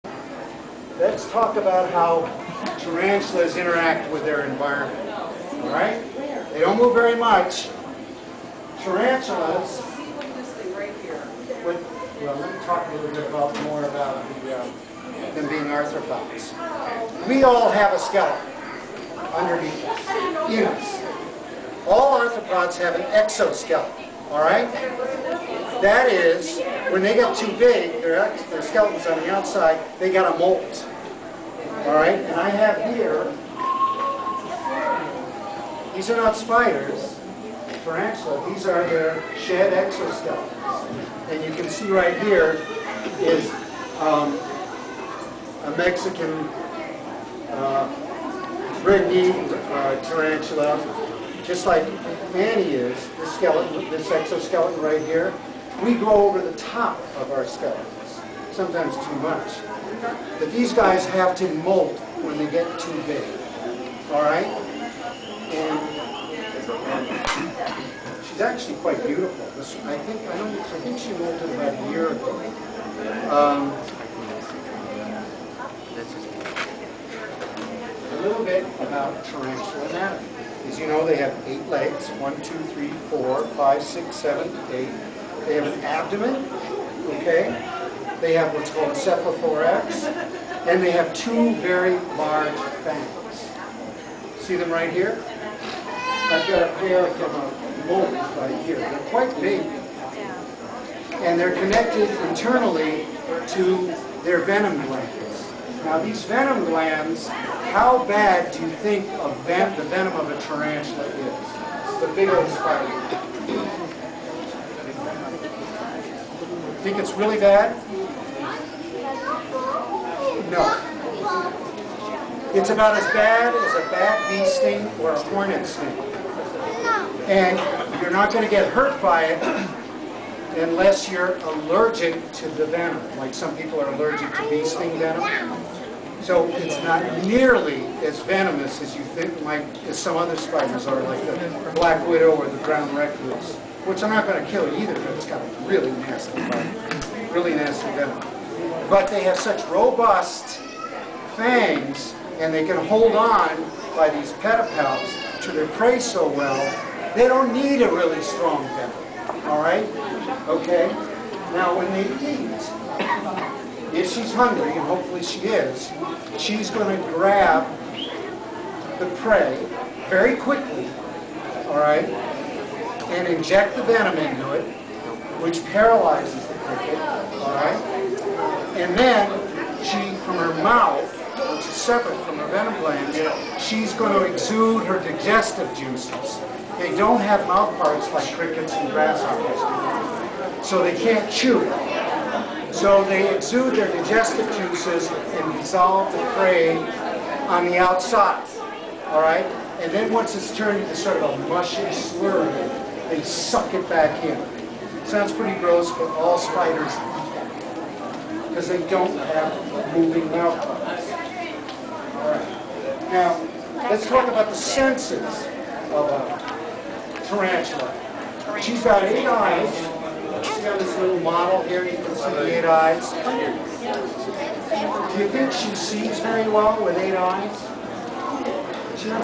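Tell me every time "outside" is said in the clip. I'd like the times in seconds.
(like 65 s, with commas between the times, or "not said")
29 s, 197 s.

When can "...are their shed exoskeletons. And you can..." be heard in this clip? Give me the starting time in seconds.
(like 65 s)
38 s.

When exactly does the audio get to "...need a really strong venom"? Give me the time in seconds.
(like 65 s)
157 s.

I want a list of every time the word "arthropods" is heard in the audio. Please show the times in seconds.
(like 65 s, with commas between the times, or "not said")
15 s, 22 s.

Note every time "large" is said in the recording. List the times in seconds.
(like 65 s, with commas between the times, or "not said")
92 s.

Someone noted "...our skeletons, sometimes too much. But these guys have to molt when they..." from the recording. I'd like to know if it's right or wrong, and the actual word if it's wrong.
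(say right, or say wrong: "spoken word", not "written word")
right.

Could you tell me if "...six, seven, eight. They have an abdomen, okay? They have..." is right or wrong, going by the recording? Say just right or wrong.
right.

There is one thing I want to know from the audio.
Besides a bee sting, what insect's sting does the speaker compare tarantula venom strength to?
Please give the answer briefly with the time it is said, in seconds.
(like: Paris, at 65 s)
hornet, at 125 s.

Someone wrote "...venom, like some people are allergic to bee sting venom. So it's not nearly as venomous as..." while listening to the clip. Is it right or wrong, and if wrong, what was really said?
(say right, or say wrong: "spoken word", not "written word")
right.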